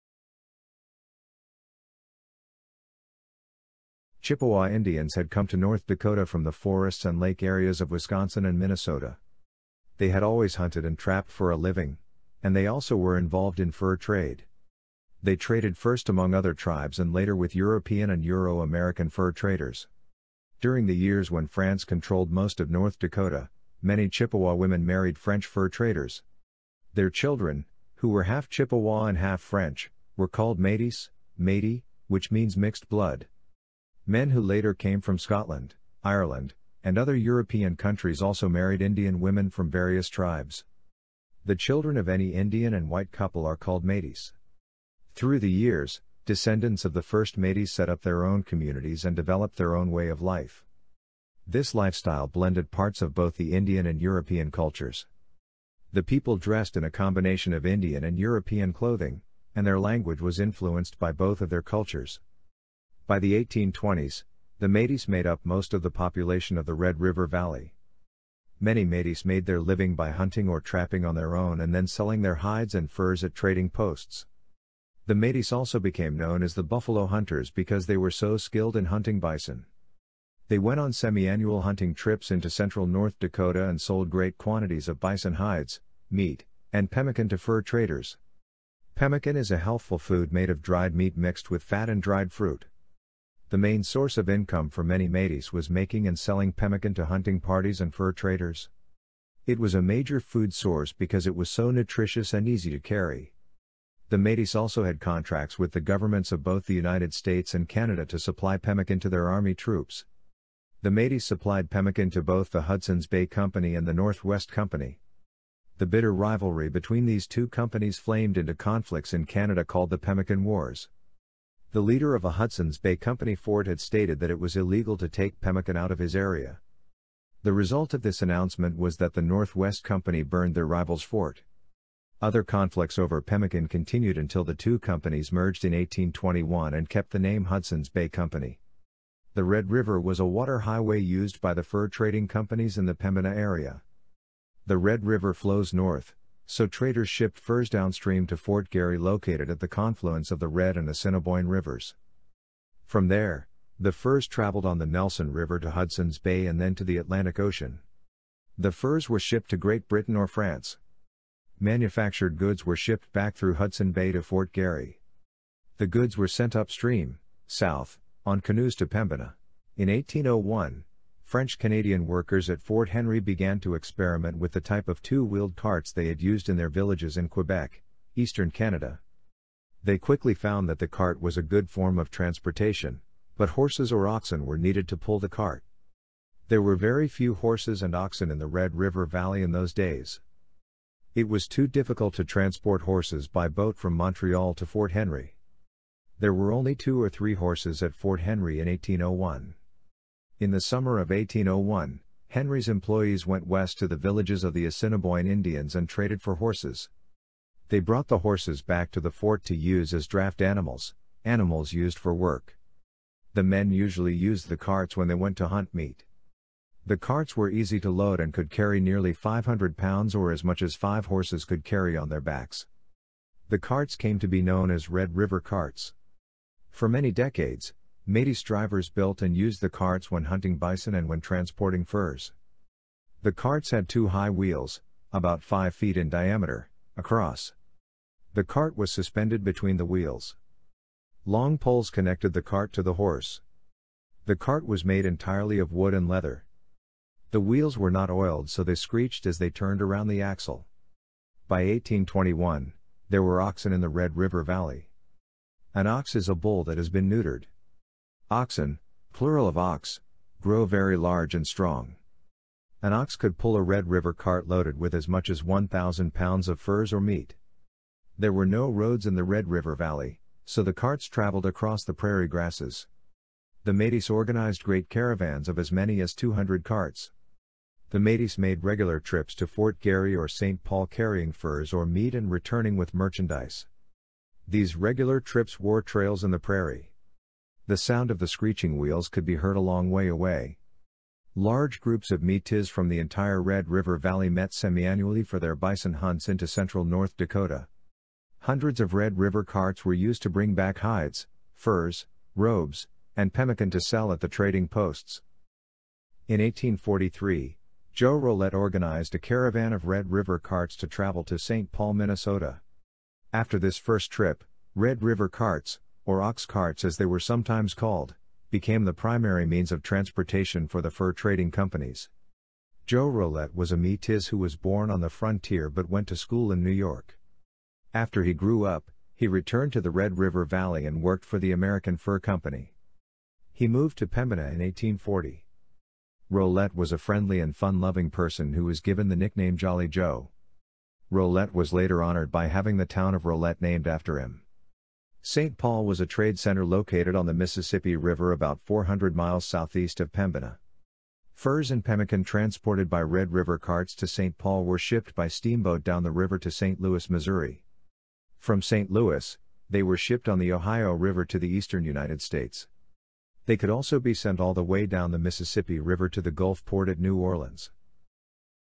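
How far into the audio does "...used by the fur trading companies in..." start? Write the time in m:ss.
2:20.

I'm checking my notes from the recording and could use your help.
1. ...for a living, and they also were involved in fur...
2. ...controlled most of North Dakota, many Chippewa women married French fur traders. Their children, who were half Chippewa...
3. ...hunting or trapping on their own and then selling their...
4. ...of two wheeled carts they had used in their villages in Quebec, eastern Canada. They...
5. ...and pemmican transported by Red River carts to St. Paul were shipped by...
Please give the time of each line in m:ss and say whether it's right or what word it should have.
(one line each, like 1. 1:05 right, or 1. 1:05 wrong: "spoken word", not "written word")
1. 0:11 right
2. 0:21 right
3. 1:10 right
4. 2:54 right
5. 5:51 right.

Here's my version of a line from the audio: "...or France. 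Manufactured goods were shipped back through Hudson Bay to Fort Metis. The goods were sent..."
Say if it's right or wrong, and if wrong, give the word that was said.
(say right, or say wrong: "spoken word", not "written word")
wrong: "Garry", not "Metis".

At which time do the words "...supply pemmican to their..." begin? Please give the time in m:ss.
1:48.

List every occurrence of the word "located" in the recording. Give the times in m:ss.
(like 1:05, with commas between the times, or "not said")
2:28, 5:46.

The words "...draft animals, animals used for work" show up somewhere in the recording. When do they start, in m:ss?
3:30.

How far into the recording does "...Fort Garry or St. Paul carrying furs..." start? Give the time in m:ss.
4:39.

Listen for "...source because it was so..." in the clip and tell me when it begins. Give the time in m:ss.
1:40.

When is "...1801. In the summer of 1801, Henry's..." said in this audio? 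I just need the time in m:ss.
3:18.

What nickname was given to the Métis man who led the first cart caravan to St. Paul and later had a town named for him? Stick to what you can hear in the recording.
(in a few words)
Jolly Joe.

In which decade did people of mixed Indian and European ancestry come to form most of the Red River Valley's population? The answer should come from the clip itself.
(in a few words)
1820s.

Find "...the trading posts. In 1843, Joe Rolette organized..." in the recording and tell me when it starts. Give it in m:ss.
5:04.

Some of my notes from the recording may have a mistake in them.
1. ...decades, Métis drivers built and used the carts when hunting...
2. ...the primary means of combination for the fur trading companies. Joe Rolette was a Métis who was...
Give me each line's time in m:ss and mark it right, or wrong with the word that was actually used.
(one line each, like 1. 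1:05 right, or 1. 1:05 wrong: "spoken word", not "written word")
1. 3:47 right
2. 5:18 wrong: "transportation", not "combination".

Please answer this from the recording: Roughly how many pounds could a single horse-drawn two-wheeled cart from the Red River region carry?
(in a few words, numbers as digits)
500 pounds.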